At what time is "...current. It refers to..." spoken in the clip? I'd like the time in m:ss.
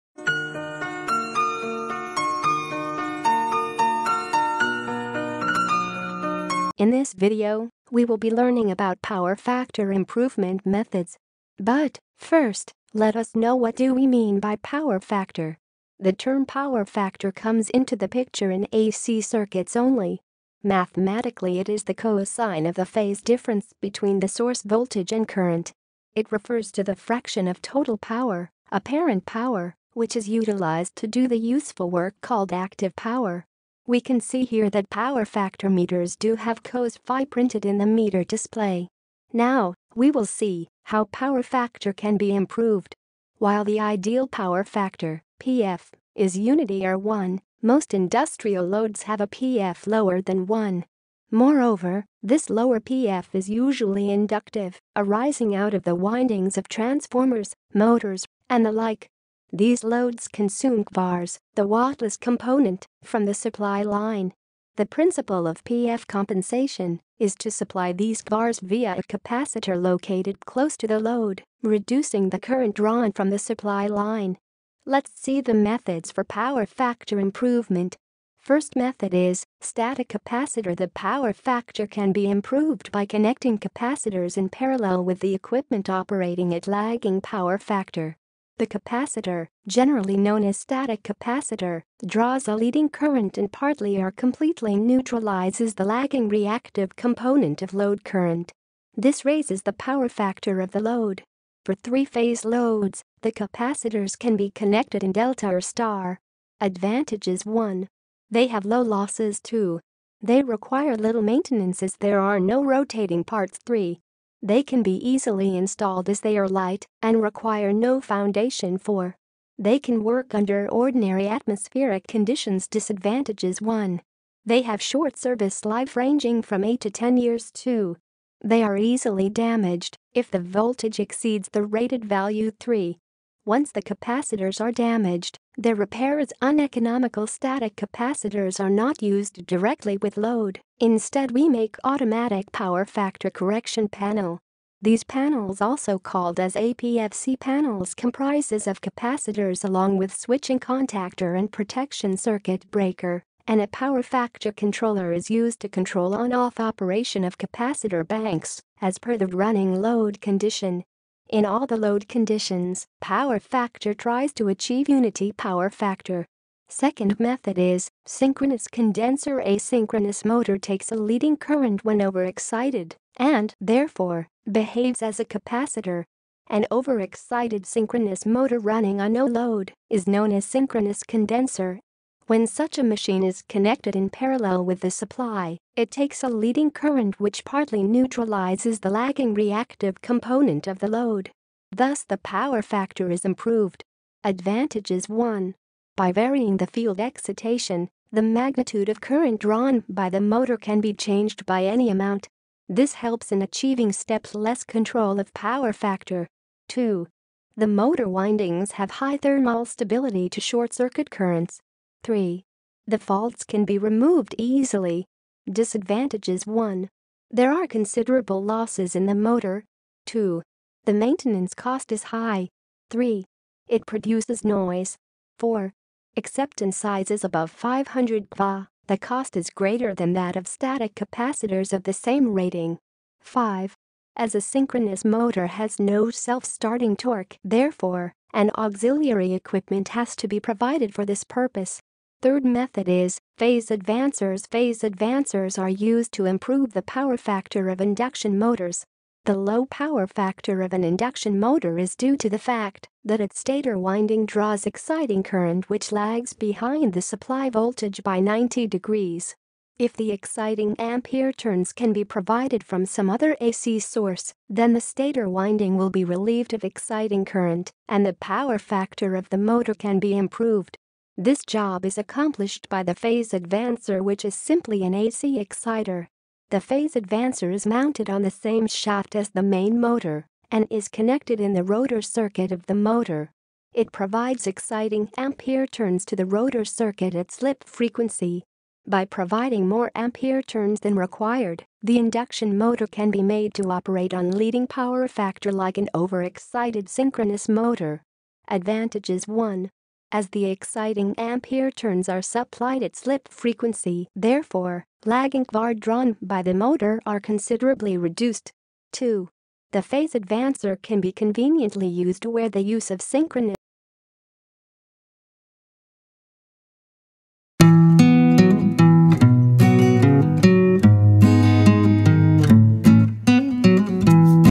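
0:25.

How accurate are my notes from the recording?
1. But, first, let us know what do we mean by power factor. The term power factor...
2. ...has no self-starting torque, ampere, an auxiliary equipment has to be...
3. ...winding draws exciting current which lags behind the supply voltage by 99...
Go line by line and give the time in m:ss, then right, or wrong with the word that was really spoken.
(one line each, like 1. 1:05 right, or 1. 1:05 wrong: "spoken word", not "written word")
1. 0:11 right
2. 3:55 wrong: "therefore", not "ampere"
3. 4:13 wrong: "90", not "99".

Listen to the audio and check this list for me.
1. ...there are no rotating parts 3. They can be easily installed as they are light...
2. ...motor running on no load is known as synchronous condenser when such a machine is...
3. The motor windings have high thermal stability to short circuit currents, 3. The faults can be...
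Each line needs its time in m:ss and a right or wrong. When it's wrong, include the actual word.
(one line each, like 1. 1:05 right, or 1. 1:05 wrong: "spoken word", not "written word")
1. 1:51 right
2. 2:58 right
3. 3:27 right.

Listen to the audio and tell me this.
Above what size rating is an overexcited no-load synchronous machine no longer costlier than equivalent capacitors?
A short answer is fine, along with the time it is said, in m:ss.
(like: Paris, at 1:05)
500 kVA, at 3:47.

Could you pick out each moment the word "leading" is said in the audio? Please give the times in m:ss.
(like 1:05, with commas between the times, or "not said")
1:32, 2:50, 3:06, 4:54.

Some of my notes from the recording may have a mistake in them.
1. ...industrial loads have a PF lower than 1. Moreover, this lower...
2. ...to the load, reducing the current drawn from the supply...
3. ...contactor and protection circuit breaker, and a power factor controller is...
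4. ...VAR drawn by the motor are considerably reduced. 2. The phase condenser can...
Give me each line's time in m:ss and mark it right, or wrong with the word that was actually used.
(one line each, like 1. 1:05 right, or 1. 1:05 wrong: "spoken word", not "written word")
1. 0:47 right
2. 1:10 right
3. 2:30 right
4. 5:05 wrong: "advancer", not "condenser".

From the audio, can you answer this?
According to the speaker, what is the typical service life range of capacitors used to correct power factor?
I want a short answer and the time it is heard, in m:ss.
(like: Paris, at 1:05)
8 to 10 years, at 2:06.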